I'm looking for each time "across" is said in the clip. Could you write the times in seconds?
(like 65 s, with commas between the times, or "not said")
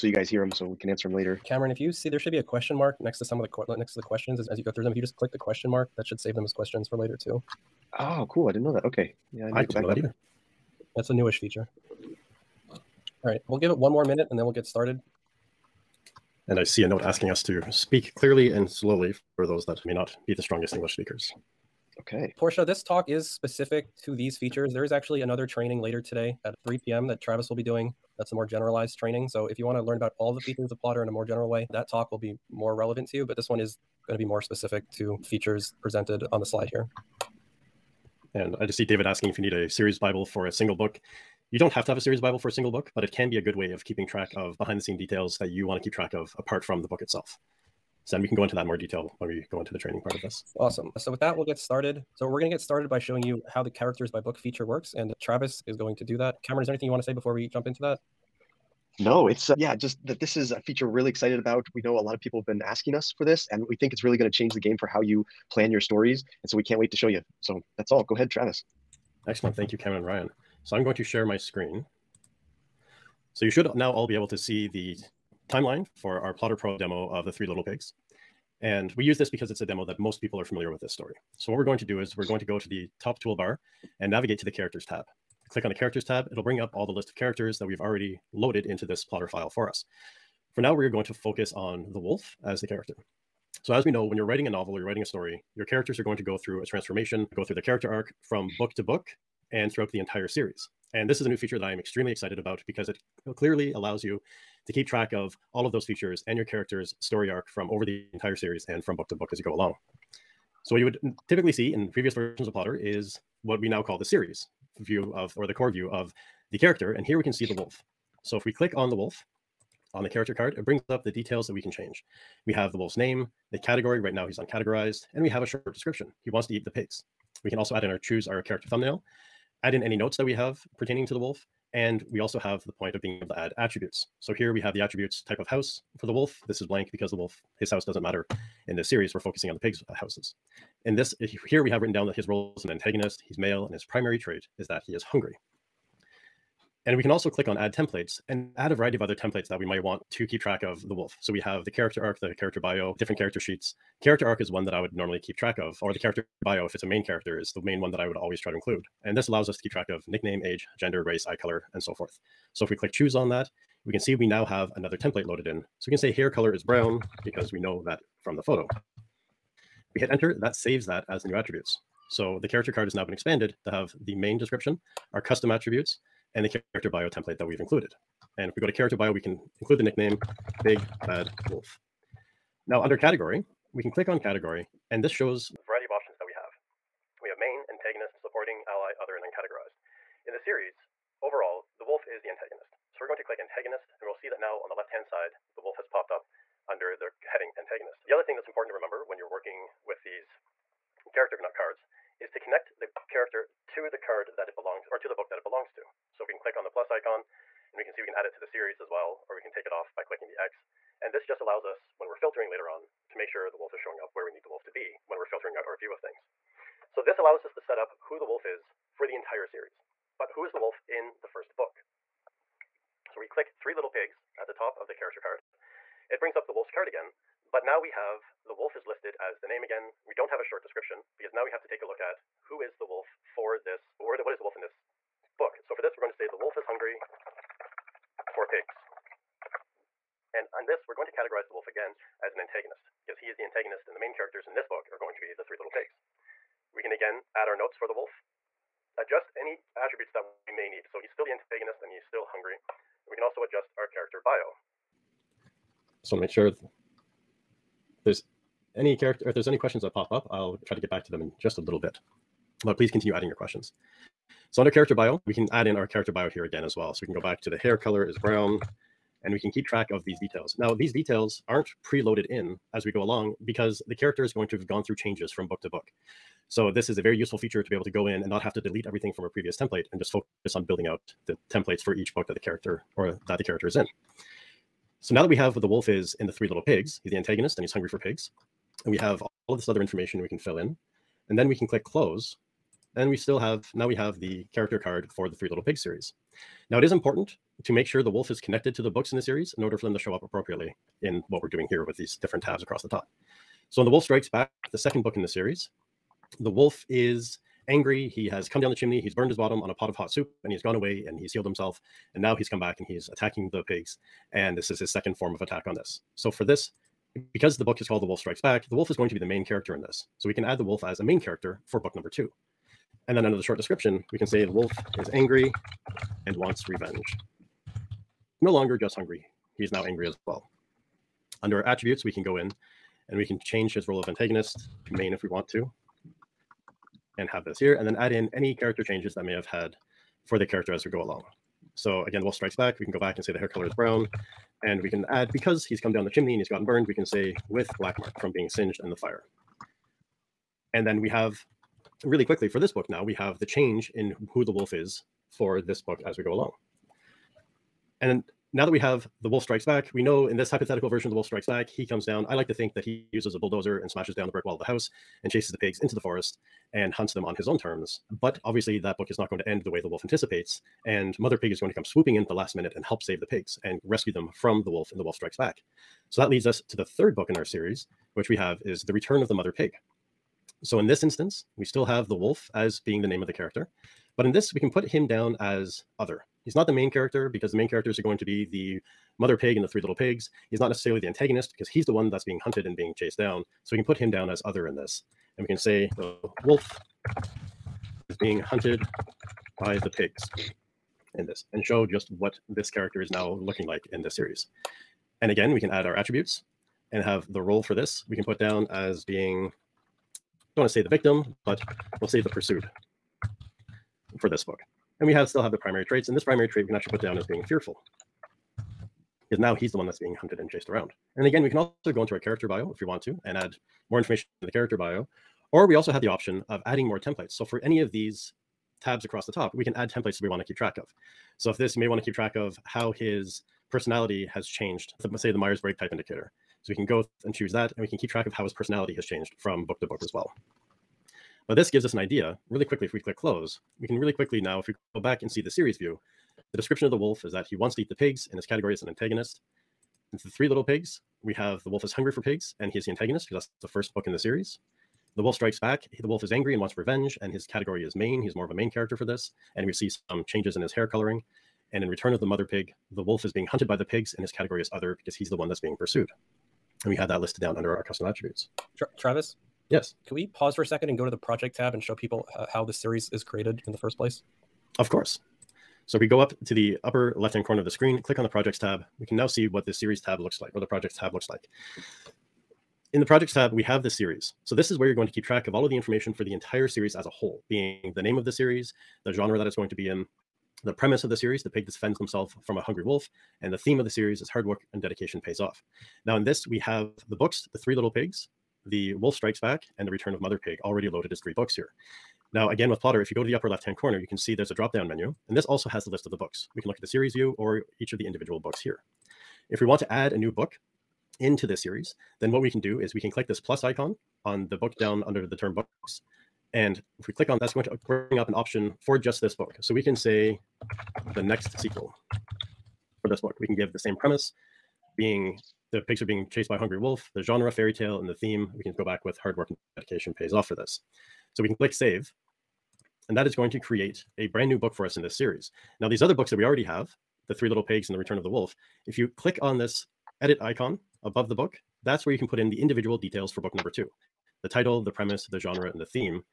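302 s, 429 s.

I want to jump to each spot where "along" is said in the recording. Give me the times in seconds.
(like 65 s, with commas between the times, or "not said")
109 s, 273 s, 341 s, 356 s.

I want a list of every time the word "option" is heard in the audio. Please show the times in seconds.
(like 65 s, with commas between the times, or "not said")
185 s, 426 s, 518 s.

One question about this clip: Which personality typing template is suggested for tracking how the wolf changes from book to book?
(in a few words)
Myers-Briggs type indicator.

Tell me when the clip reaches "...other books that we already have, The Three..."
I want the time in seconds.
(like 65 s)
536 s.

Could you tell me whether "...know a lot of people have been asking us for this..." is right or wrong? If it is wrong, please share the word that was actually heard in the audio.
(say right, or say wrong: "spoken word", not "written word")
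right.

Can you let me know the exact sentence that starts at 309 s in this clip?
He's burned his bottom on a pot of hot soup and he's gone away and he's healed himself.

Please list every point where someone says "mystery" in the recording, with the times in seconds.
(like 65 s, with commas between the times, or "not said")
not said.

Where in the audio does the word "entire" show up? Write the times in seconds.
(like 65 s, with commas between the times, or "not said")
99 s, 108 s, 219 s, 486 s.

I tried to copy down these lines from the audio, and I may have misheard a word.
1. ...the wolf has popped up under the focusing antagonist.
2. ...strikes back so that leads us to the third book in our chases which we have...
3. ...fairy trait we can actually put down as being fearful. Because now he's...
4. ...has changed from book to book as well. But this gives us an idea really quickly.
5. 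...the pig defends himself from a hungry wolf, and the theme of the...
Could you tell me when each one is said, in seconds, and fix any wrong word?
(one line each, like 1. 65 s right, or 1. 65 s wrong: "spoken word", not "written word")
1. 195 s wrong: "heading", not "focusing"
2. 375 s wrong: "series", not "chases"
3. 416 s wrong: "primary", not "fairy"
4. 438 s right
5. 491 s right.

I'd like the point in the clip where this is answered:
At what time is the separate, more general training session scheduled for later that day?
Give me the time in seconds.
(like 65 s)
26 s.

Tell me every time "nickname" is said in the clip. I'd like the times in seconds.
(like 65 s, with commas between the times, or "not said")
160 s, 179 s.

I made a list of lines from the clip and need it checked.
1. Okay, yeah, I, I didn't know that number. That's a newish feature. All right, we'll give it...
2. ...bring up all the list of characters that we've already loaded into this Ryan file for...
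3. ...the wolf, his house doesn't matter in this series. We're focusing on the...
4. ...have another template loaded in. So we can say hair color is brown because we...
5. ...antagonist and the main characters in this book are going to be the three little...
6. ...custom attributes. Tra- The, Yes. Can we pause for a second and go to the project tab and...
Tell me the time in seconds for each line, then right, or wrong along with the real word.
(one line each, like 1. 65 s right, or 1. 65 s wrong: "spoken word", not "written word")
1. 8 s wrong: "either", not "number"
2. 86 s wrong: "Plottr", not "Ryan"
3. 137 s right
4. 164 s right
5. 243 s right
6. 467 s wrong: "Travis", not "The".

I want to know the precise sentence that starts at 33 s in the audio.
But this one is going to be more specific to features presented on the slide here.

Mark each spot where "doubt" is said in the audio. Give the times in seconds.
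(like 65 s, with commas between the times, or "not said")
not said.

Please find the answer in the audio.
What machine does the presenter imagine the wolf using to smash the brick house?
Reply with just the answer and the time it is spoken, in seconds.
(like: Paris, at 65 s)
A bulldozer, at 363 s.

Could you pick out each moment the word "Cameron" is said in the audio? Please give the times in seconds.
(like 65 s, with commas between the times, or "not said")
1 s, 56 s, 69 s.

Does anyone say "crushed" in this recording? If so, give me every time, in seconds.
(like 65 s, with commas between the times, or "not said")
not said.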